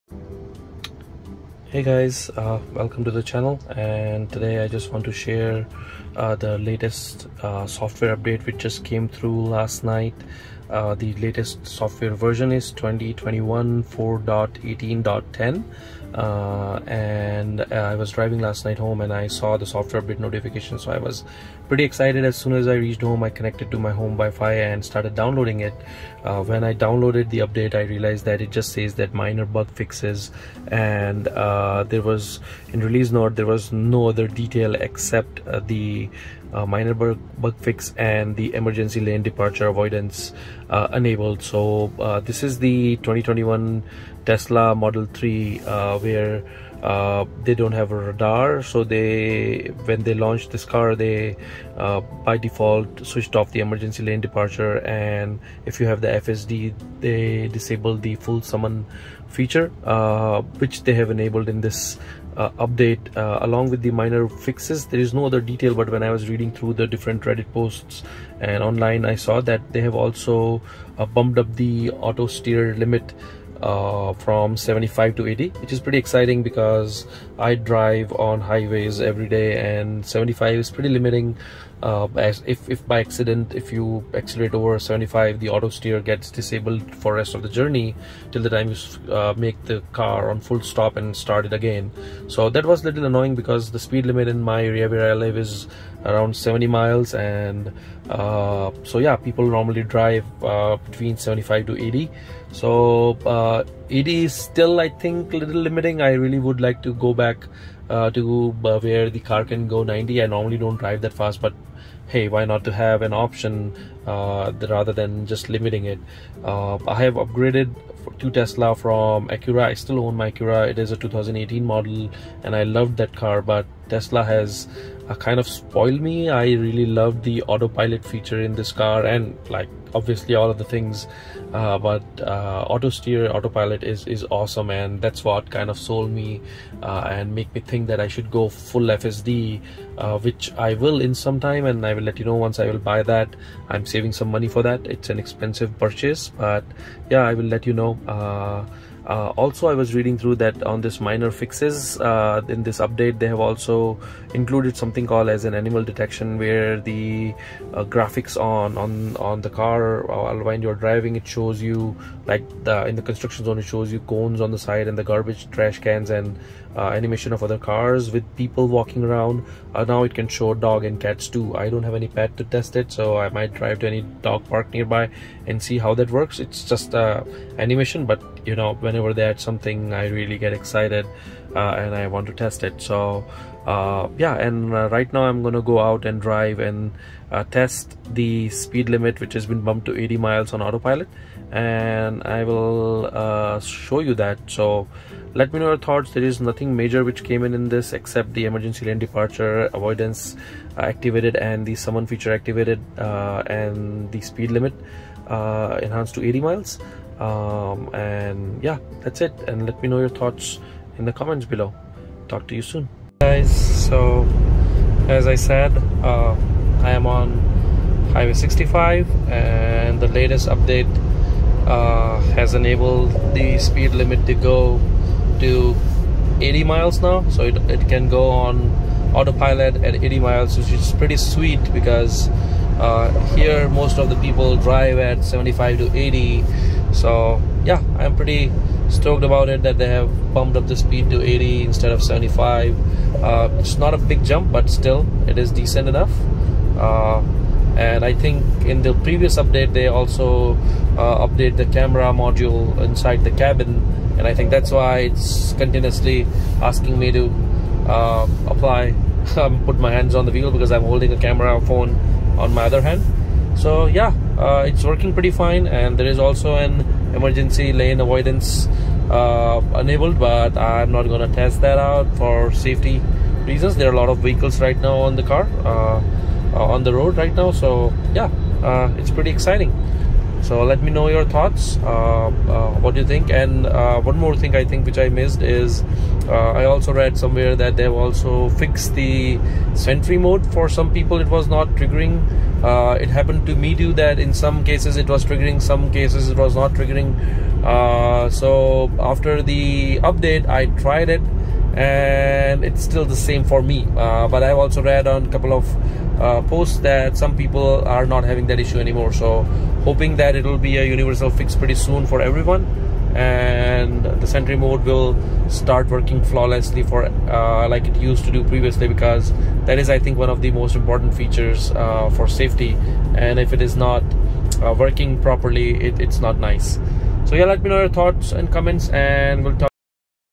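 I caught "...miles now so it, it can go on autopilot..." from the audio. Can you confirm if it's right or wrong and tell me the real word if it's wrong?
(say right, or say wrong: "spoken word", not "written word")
right.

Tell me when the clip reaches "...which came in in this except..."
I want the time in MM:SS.
03:17.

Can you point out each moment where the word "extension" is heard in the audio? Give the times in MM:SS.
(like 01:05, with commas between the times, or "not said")
not said.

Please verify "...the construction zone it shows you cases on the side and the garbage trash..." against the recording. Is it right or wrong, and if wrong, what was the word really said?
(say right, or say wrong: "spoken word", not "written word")
wrong: "cones", not "cases".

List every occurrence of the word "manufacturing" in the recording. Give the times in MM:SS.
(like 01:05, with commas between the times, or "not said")
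not said.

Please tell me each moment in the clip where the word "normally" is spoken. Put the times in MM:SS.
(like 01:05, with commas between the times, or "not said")
01:39, 01:50.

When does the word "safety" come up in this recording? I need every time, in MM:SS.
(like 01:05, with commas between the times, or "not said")
04:32, 05:22.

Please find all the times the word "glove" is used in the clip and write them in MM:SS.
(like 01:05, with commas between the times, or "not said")
not said.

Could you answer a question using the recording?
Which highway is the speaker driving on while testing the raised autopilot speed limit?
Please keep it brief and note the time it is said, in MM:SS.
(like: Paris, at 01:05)
Highway 65, at 03:38.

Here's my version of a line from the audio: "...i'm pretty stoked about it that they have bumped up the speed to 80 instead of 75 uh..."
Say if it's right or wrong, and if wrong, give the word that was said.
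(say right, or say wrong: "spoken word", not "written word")
right.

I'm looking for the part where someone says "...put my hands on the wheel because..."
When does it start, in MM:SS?
04:19.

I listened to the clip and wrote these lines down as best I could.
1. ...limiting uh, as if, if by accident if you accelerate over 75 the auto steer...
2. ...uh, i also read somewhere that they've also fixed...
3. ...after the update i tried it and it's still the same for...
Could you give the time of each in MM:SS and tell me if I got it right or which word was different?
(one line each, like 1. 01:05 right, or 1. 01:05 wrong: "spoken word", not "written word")
1. 01:20 right
2. 04:46 right
3. 04:58 right.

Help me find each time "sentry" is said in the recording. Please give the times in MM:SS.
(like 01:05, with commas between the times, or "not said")
04:49, 05:14.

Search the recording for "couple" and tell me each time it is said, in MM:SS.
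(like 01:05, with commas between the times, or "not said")
05:05.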